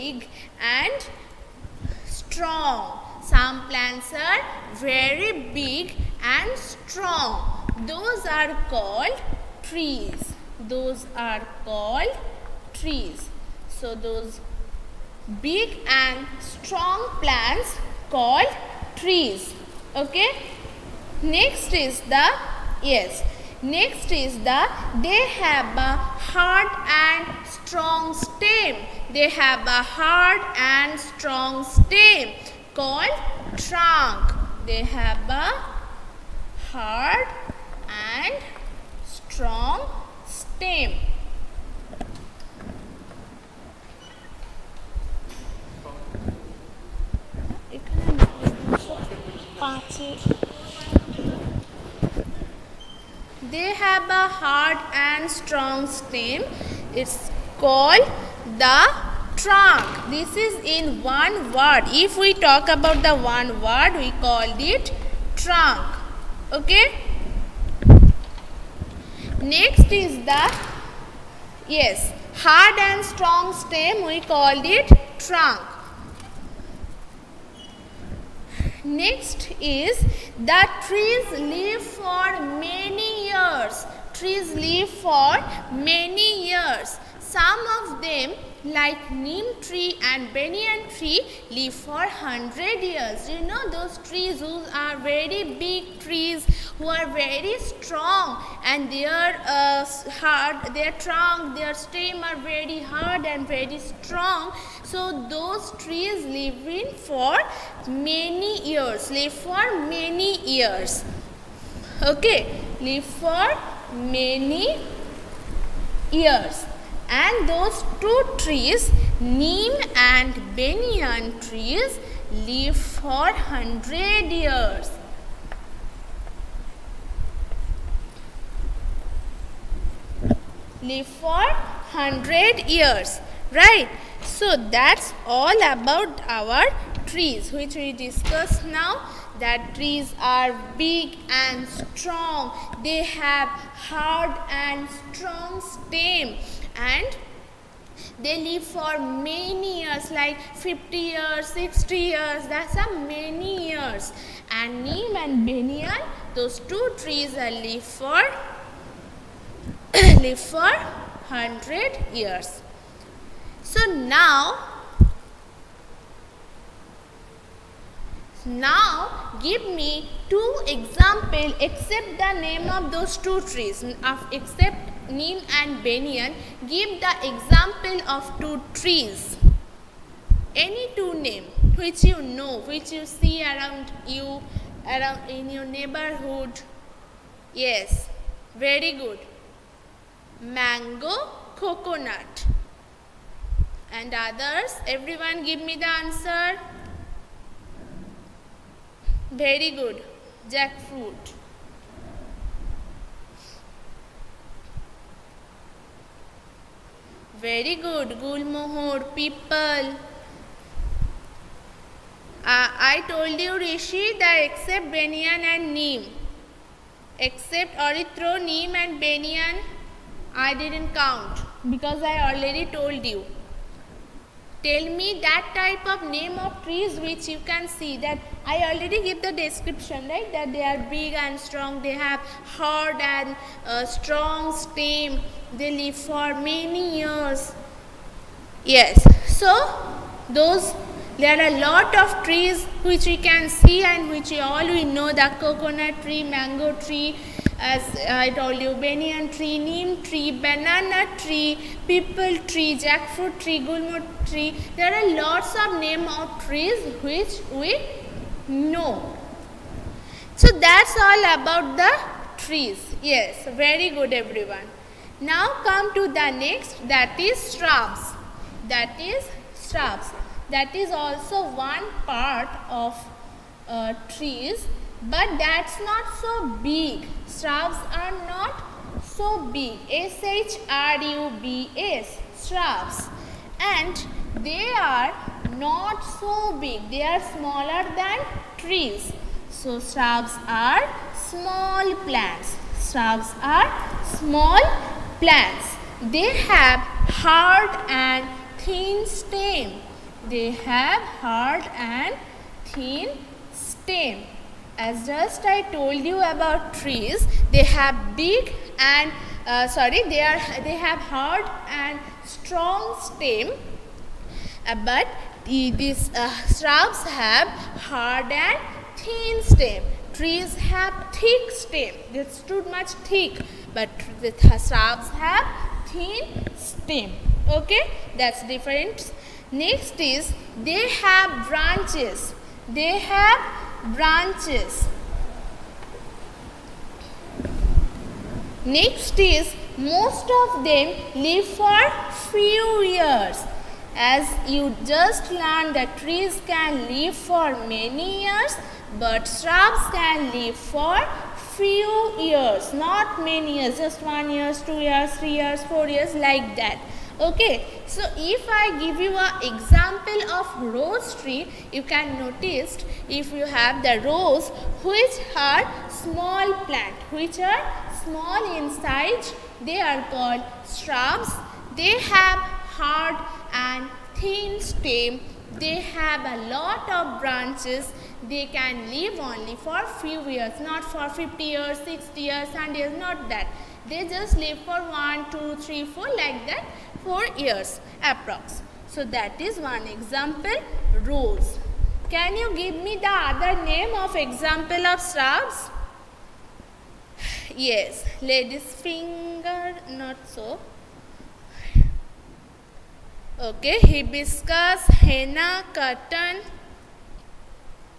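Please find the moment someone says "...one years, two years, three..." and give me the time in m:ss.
5:54.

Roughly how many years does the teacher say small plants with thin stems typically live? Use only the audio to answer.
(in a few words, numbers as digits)
4 years.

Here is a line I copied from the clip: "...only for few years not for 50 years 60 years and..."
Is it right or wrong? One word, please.
right.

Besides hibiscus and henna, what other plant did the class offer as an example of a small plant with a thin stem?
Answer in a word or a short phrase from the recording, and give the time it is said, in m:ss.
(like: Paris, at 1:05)
cotton, at 6:45.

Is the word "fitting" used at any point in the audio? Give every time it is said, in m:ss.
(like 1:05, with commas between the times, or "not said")
not said.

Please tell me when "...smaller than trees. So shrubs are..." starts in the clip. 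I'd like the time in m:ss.
4:47.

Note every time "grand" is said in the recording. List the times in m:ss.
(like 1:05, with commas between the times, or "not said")
not said.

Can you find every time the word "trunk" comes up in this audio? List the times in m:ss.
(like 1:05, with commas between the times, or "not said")
0:33, 0:59, 1:05, 1:15, 1:41.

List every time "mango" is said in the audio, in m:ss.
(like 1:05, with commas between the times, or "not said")
3:10, 4:06.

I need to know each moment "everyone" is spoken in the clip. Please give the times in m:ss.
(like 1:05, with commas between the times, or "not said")
3:14, 4:24.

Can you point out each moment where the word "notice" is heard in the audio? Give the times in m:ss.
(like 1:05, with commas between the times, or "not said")
6:02.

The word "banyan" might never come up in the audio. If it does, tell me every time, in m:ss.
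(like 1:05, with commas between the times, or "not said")
1:30, 2:00, 2:35, 2:55, 3:34, 3:38, 4:08.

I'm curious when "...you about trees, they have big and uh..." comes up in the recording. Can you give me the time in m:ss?
5:06.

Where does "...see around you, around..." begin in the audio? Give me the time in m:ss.
3:03.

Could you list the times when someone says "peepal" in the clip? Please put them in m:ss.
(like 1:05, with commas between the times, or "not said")
3:29, 4:11.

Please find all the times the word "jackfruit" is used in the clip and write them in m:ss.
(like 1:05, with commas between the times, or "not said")
3:20, 4:12.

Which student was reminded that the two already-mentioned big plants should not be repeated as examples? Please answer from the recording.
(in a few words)
Rishi.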